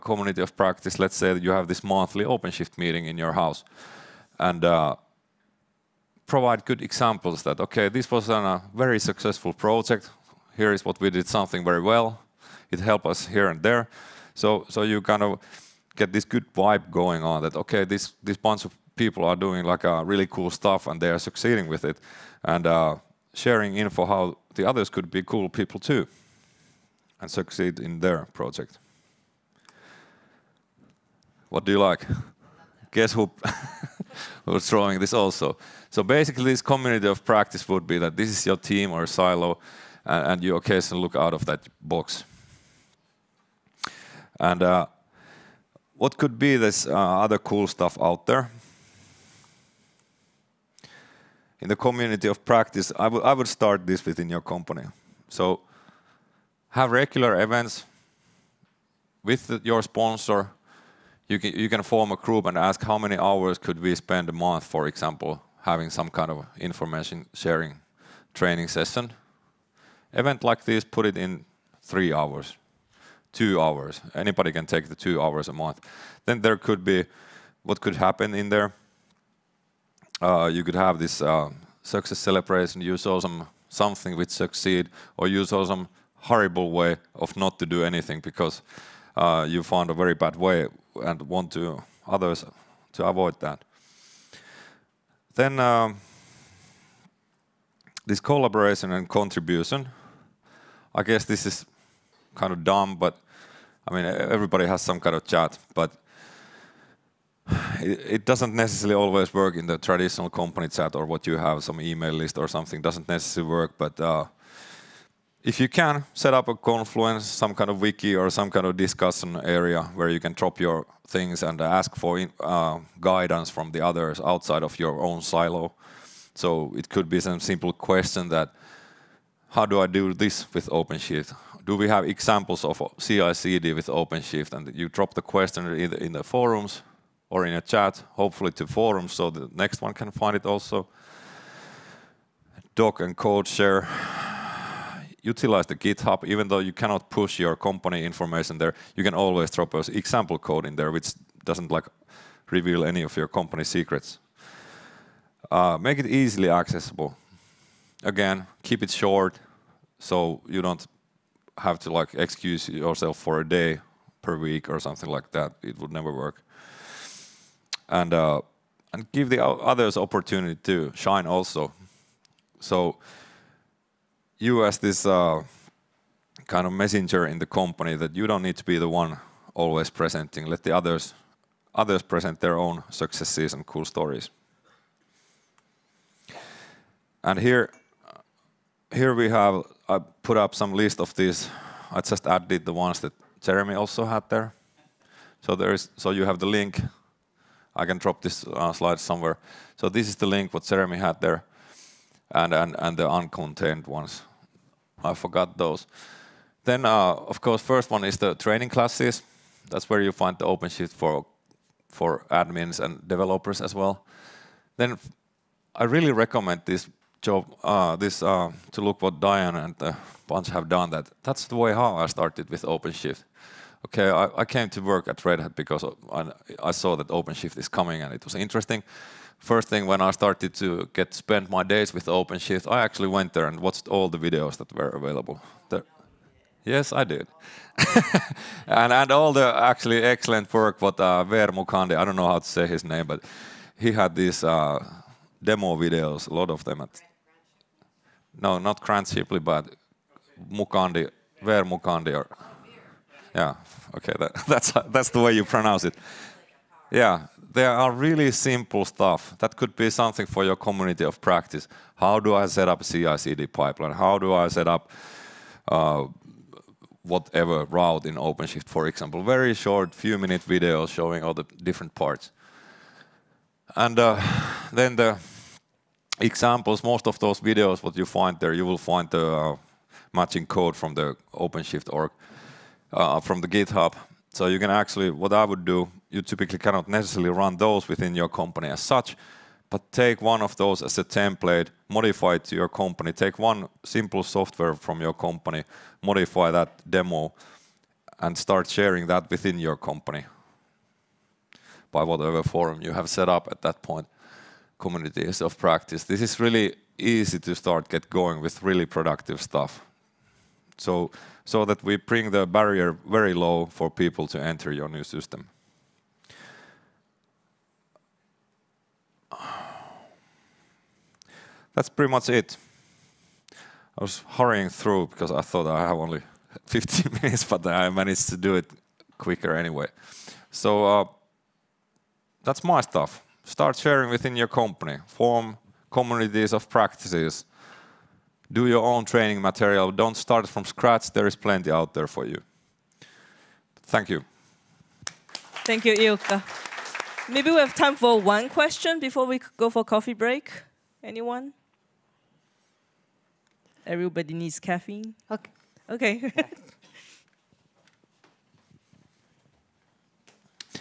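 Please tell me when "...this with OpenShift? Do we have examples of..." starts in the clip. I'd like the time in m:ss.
2:10.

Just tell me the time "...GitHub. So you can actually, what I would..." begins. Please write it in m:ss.
4:43.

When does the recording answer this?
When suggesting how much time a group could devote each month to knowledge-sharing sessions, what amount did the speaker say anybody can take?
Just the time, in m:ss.
1:14.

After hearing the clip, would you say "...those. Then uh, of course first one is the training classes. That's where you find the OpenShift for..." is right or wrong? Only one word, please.
right.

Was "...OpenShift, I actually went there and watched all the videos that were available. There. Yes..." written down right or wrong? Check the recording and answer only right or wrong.
right.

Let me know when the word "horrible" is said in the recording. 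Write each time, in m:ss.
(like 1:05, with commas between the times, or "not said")
1:26.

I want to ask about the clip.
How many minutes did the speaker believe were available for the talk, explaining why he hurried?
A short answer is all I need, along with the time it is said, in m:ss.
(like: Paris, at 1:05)
15, at 5:26.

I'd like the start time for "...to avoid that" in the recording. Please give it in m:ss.
1:32.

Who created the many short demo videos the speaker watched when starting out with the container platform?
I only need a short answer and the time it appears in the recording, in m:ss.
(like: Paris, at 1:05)
Veer Muchandi, at 4:11.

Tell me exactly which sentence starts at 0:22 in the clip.
And uh, sharing info how the others could be cool people too and succeed in their project.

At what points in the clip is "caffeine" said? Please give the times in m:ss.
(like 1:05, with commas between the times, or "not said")
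5:54.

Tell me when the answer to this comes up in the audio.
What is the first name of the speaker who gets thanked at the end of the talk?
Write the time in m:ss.
5:45.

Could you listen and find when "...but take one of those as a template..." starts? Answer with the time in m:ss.
4:49.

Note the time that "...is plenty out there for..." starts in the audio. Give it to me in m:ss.
5:41.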